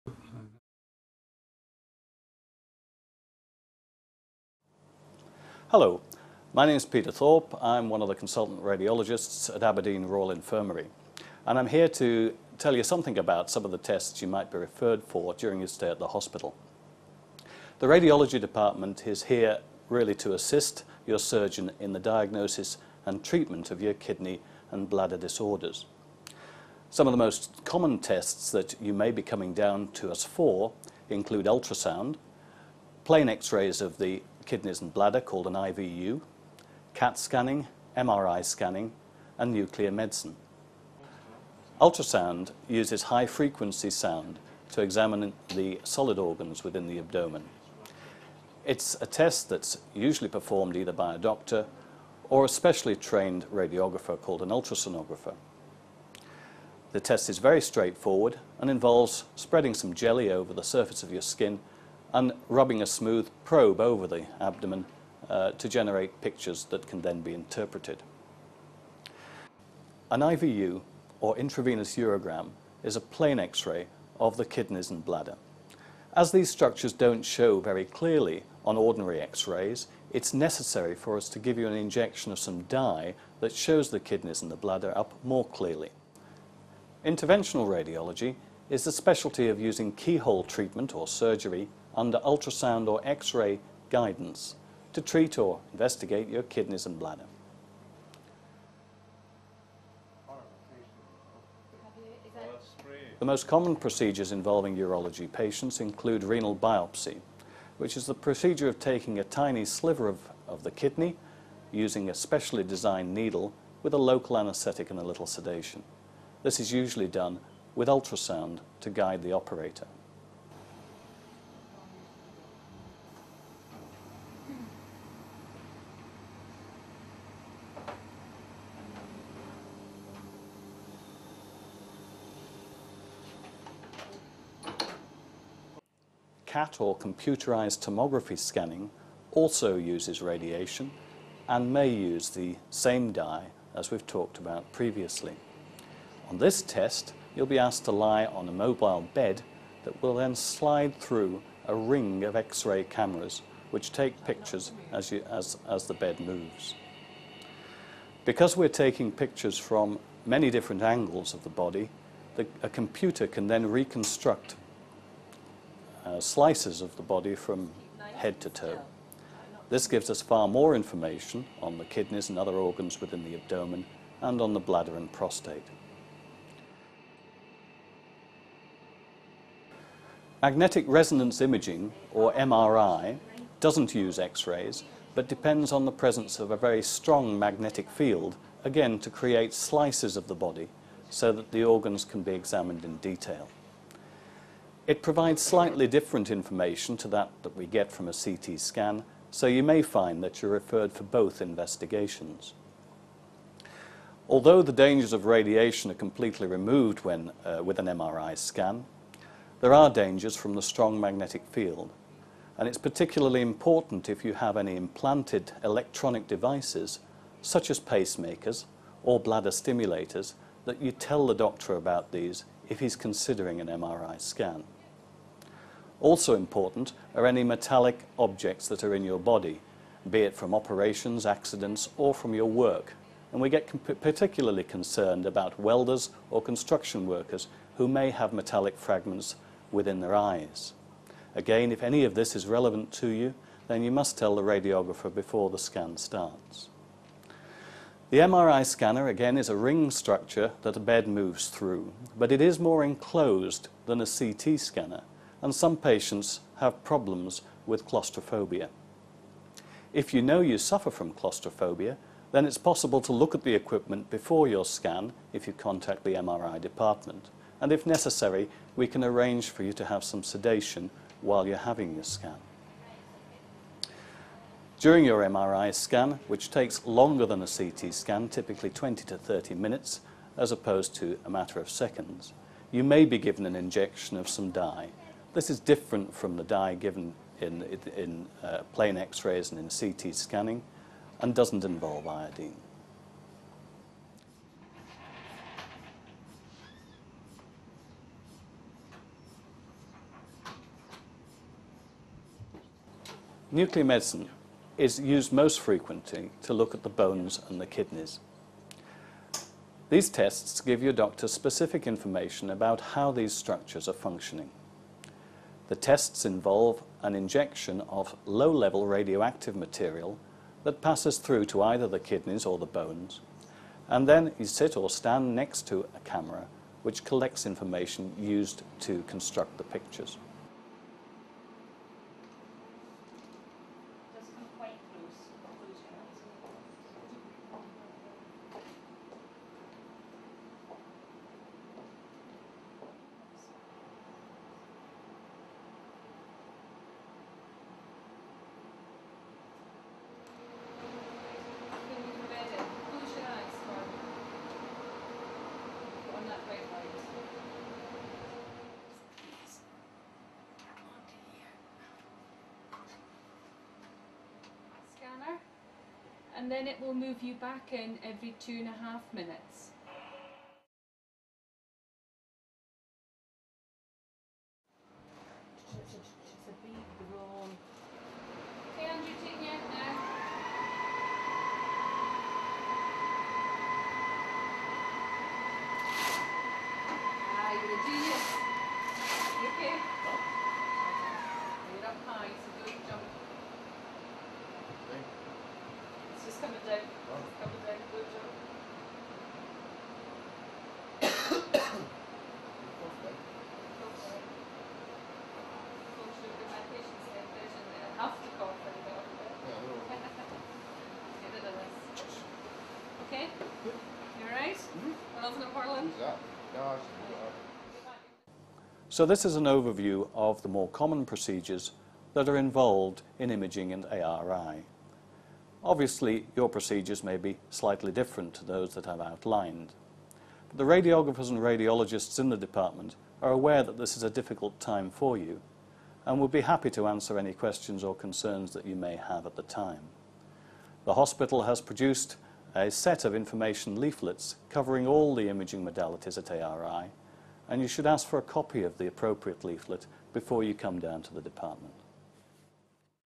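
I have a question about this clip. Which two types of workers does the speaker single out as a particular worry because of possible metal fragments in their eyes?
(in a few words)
welders or construction workers.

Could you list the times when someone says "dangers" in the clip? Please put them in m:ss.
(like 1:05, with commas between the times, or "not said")
3:24, 3:29.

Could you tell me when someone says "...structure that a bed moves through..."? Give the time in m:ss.
4:09.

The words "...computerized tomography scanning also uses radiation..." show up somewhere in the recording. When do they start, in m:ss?
2:16.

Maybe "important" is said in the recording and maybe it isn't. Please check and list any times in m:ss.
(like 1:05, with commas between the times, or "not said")
3:33, 3:46.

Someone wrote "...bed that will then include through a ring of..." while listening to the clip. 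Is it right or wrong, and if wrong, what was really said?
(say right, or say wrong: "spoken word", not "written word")
wrong: "slide", not "include".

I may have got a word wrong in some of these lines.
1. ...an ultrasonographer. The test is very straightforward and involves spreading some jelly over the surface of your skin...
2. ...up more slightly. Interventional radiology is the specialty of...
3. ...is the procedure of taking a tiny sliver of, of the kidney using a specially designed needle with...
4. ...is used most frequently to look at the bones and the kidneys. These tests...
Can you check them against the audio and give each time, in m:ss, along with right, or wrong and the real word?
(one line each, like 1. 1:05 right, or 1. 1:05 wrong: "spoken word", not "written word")
1. 0:54 right
2. 1:24 wrong: "clearly", not "slightly"
3. 1:47 right
4. 5:04 right.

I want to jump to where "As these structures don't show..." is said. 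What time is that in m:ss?
1:16.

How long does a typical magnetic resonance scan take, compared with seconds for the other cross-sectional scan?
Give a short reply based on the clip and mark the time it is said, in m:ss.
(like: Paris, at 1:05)
20 to 30 minutes, at 4:38.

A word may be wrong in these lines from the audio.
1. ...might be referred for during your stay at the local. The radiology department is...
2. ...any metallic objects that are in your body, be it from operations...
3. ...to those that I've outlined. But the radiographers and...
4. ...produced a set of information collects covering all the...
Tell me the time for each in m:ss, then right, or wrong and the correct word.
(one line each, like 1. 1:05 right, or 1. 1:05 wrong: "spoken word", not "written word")
1. 0:14 wrong: "hospital", not "local"
2. 3:47 right
3. 7:08 right
4. 7:21 wrong: "leaflets", not "collects".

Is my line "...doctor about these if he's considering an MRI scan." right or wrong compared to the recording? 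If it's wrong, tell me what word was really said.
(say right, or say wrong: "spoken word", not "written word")
right.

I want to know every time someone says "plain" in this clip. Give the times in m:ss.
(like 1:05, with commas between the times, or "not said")
0:33, 1:13, 4:48.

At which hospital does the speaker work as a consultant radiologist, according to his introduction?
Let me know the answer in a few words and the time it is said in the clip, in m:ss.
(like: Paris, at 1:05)
Aberdeen Royal Infirmary, at 0:09.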